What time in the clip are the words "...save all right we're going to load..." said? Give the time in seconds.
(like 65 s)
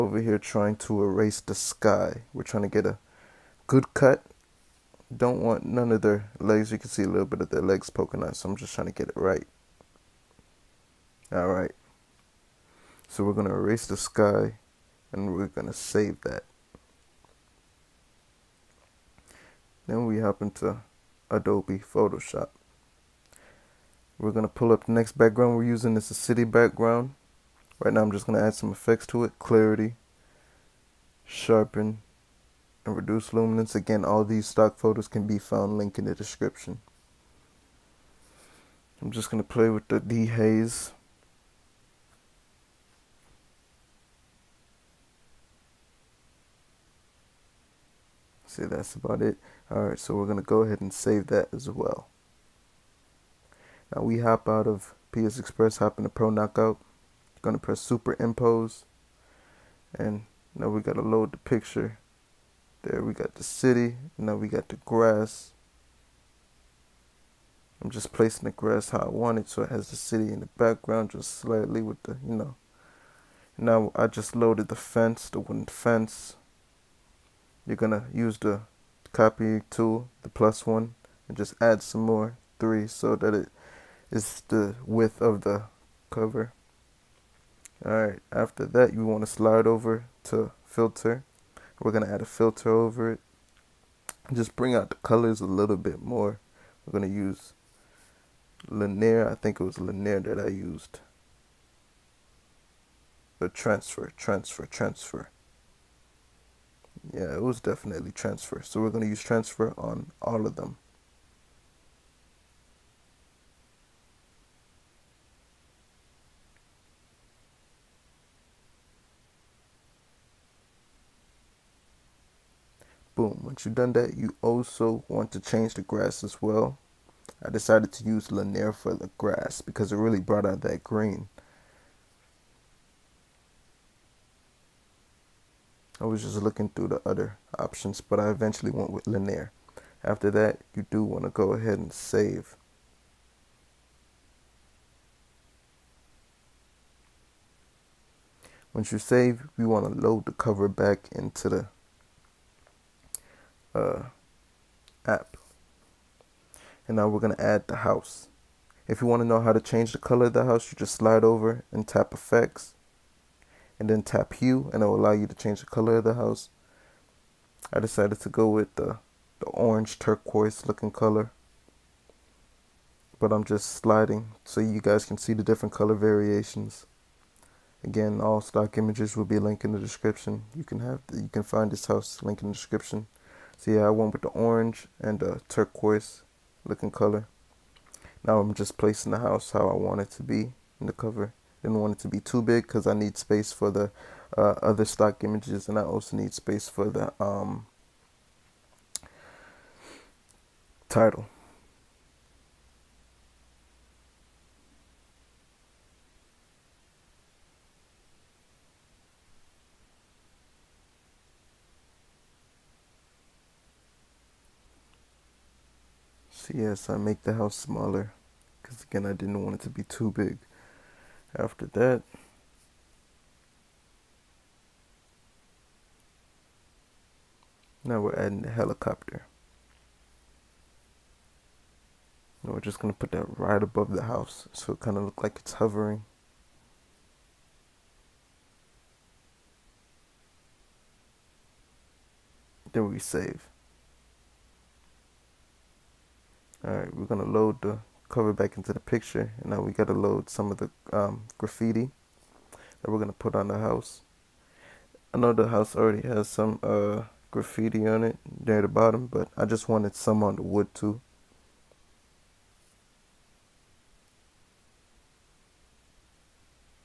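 242 s.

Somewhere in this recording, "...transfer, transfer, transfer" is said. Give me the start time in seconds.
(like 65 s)
103 s.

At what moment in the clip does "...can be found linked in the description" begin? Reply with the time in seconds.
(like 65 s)
35 s.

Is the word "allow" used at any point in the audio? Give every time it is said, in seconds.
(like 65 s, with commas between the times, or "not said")
164 s.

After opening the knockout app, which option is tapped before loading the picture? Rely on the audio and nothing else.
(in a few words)
Super Impose.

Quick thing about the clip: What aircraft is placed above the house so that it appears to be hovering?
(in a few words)
helicopter.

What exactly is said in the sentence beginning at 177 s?
Again, all stock images will be linked in the description.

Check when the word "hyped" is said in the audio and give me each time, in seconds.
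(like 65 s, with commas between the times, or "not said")
not said.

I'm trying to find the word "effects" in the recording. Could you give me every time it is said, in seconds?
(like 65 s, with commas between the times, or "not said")
28 s, 162 s.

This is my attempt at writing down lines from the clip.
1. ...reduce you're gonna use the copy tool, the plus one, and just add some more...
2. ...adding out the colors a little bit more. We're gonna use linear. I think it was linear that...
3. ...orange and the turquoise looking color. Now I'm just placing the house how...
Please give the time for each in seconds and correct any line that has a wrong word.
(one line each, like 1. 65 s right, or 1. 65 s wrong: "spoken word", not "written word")
1. 75 s wrong: "fence", not "reduce"
2. 94 s wrong: "bring", not "adding"
3. 184 s right.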